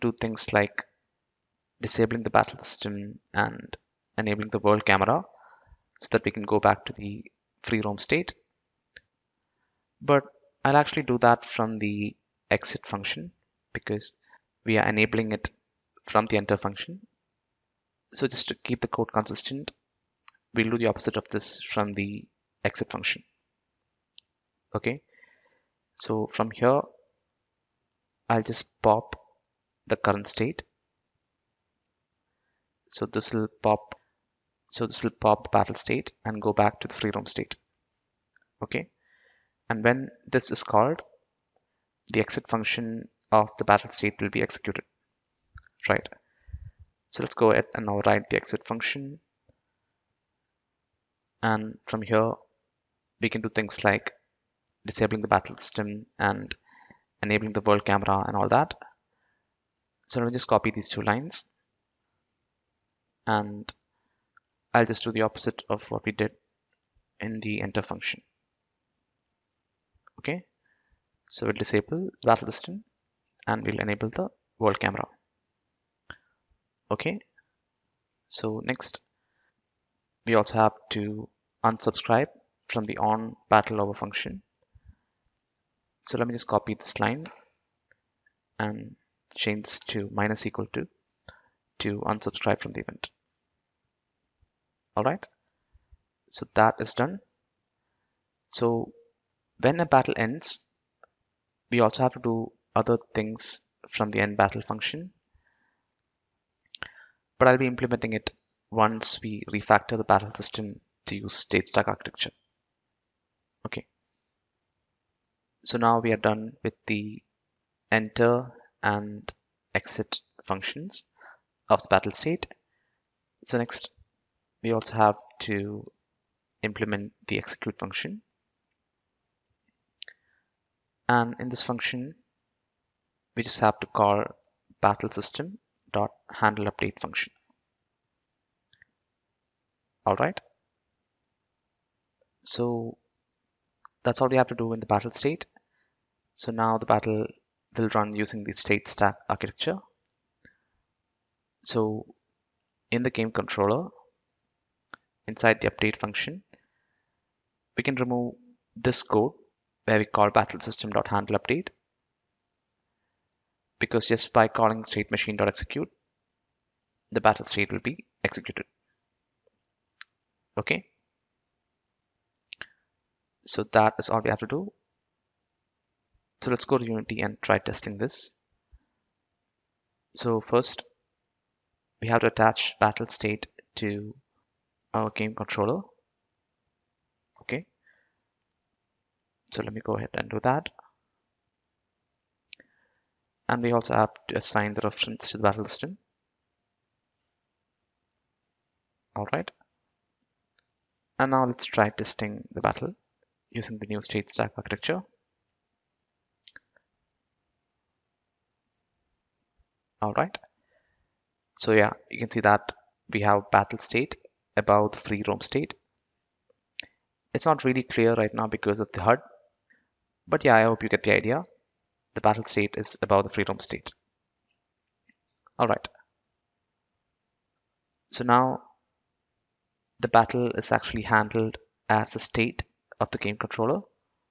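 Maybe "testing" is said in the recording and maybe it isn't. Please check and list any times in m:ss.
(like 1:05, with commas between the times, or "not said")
2:57, 3:21.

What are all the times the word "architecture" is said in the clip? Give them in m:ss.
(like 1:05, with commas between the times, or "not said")
1:51, 2:29, 3:24.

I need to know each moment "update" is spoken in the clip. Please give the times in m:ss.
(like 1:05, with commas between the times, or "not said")
2:16, 2:35, 2:40.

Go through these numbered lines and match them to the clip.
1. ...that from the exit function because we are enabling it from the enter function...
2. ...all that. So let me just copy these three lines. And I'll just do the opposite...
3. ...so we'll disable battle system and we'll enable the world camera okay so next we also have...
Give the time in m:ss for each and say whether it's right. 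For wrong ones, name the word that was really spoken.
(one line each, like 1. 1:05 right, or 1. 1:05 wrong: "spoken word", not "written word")
1. 0:11 right
2. 0:58 wrong: "two", not "three"
3. 1:11 right.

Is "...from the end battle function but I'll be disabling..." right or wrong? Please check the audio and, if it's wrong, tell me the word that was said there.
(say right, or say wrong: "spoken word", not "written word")
wrong: "implementing", not "disabling".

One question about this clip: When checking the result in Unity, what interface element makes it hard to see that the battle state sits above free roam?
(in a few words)
HUD.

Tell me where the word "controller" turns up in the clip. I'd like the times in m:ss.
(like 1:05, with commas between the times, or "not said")
2:33, 3:05, 3:53.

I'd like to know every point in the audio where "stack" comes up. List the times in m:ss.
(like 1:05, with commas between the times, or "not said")
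1:51, 2:28, 3:24.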